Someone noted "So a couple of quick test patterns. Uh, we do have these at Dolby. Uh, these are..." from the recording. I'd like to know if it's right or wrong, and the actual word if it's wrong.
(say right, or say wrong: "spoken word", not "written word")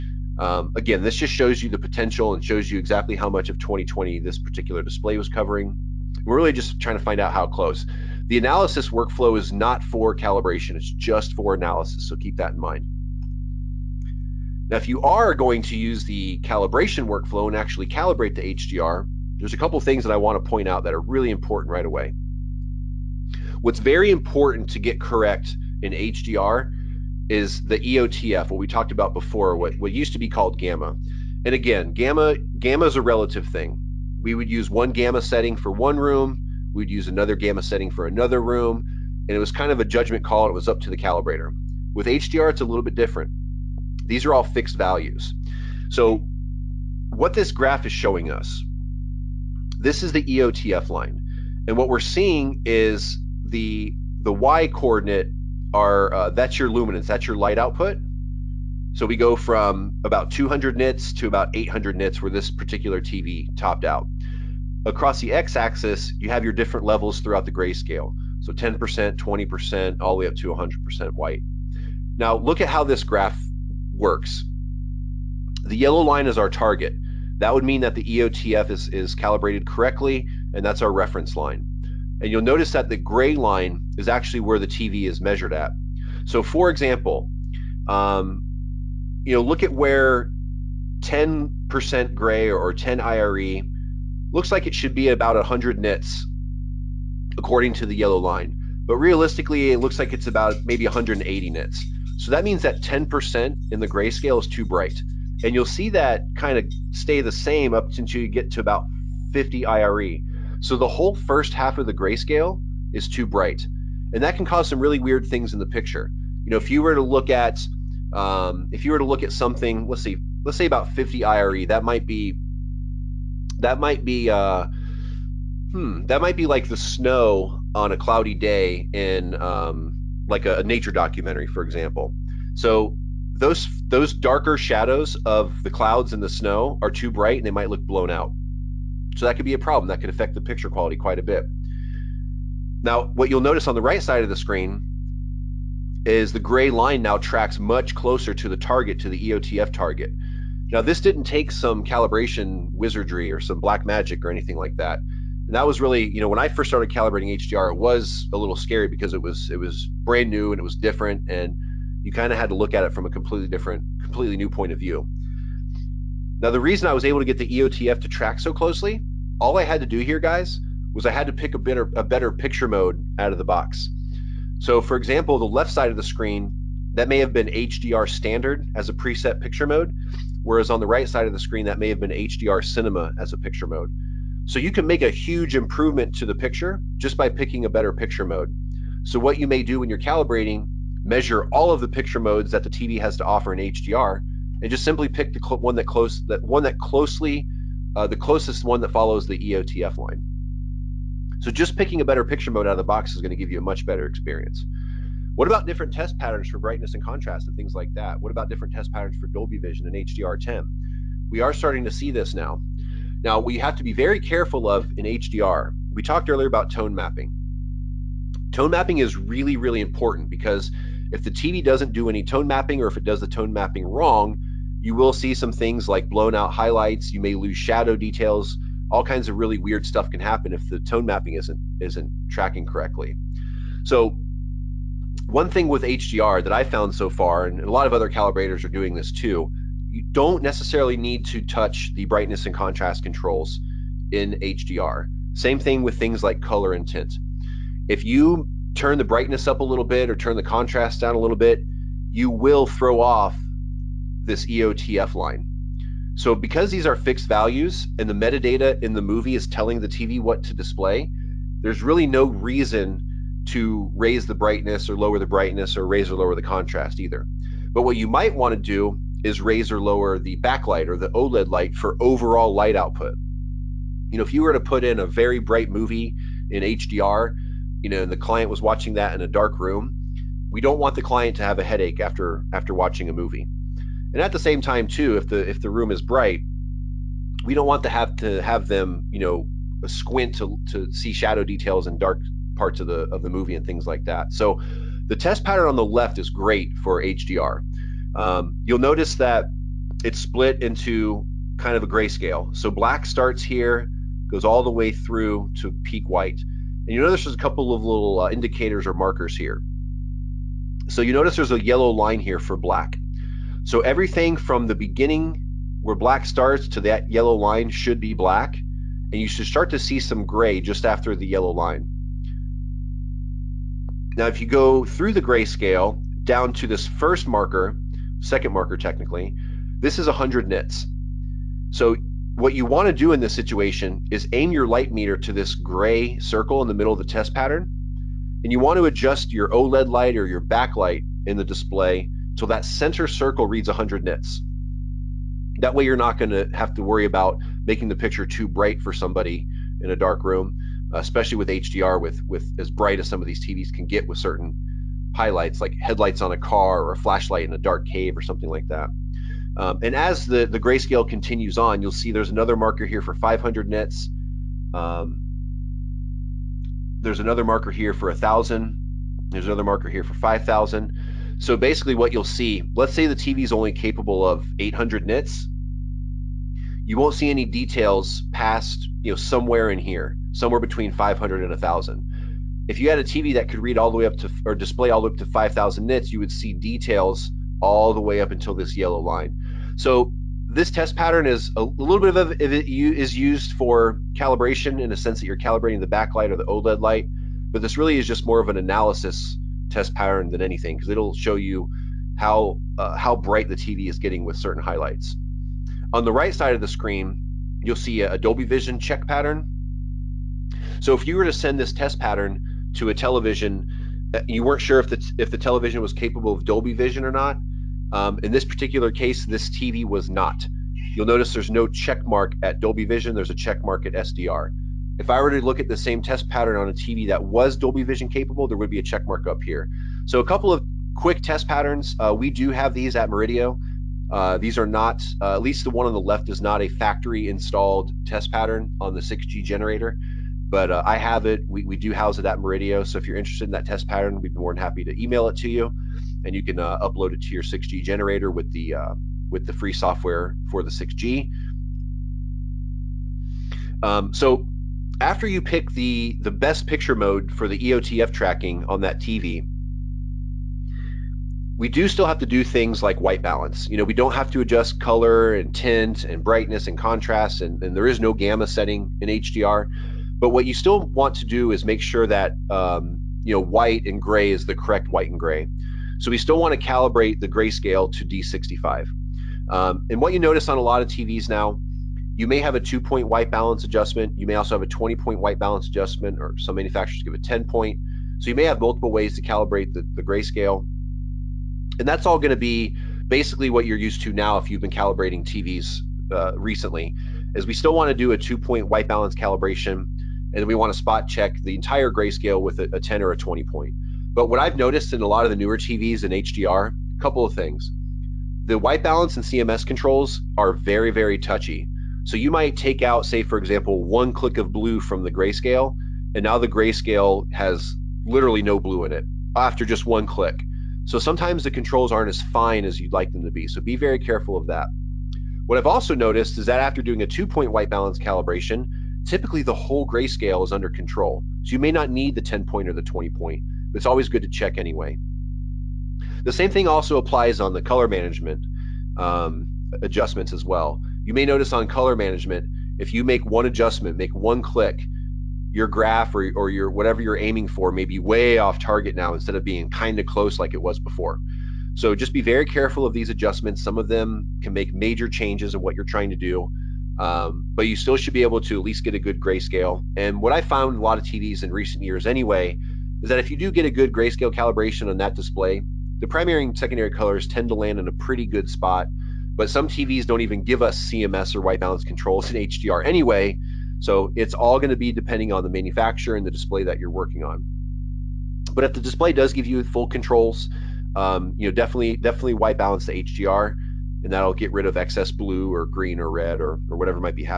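wrong: "Murideo", not "Dolby".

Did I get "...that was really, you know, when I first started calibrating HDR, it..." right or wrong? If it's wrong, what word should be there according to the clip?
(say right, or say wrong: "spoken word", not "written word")
right.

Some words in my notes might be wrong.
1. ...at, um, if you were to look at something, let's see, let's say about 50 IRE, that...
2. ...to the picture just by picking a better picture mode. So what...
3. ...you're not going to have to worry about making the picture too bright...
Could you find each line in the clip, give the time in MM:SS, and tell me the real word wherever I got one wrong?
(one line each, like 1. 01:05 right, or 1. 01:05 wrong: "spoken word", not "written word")
1. 01:57 right
2. 03:06 right
3. 05:45 right.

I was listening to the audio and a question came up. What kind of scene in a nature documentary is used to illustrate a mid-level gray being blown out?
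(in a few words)
Snow on a cloudy day.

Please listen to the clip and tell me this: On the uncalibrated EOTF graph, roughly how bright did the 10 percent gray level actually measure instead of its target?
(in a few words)
180 nits.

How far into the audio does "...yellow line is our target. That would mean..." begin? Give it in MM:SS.
01:15.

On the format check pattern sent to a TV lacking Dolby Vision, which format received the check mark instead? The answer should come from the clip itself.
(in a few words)
SDR.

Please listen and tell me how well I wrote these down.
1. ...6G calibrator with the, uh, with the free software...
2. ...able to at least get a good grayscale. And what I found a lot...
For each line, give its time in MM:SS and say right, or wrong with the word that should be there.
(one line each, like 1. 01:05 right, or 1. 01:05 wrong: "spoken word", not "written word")
1. 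07:27 wrong: "generator", not "calibrator"
2. 09:18 right.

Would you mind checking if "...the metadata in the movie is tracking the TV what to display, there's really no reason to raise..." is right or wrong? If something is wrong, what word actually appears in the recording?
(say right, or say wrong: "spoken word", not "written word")
wrong: "telling", not "tracking".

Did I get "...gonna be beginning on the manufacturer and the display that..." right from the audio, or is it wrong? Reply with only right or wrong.
wrong.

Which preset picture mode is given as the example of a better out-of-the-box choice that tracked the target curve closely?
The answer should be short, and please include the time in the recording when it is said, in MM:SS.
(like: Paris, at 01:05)
HDR cinema, at 03:02.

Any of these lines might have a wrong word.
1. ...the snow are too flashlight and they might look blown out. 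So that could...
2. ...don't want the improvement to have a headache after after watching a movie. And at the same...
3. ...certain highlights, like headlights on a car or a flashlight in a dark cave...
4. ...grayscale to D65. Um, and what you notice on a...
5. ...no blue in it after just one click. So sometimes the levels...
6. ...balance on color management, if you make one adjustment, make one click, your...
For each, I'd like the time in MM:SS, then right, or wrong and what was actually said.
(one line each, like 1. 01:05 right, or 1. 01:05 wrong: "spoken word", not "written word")
1. 02:16 wrong: "bright", not "flashlight"
2. 04:40 wrong: "client", not "improvement"
3. 05:54 right
4. 07:57 right
5. 08:38 wrong: "controls", not "levels"
6. 09:01 wrong: "notice", not "balance".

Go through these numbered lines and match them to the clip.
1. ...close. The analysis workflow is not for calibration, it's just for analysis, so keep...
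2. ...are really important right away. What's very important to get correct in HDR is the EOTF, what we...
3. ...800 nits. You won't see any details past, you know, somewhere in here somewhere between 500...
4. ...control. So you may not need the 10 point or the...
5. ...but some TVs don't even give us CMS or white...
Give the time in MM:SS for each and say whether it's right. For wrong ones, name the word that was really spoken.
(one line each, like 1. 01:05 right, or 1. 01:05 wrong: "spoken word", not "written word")
1. 00:07 right
2. 00:20 right
3. 06:14 right
4. 08:50 right
5. 09:29 right.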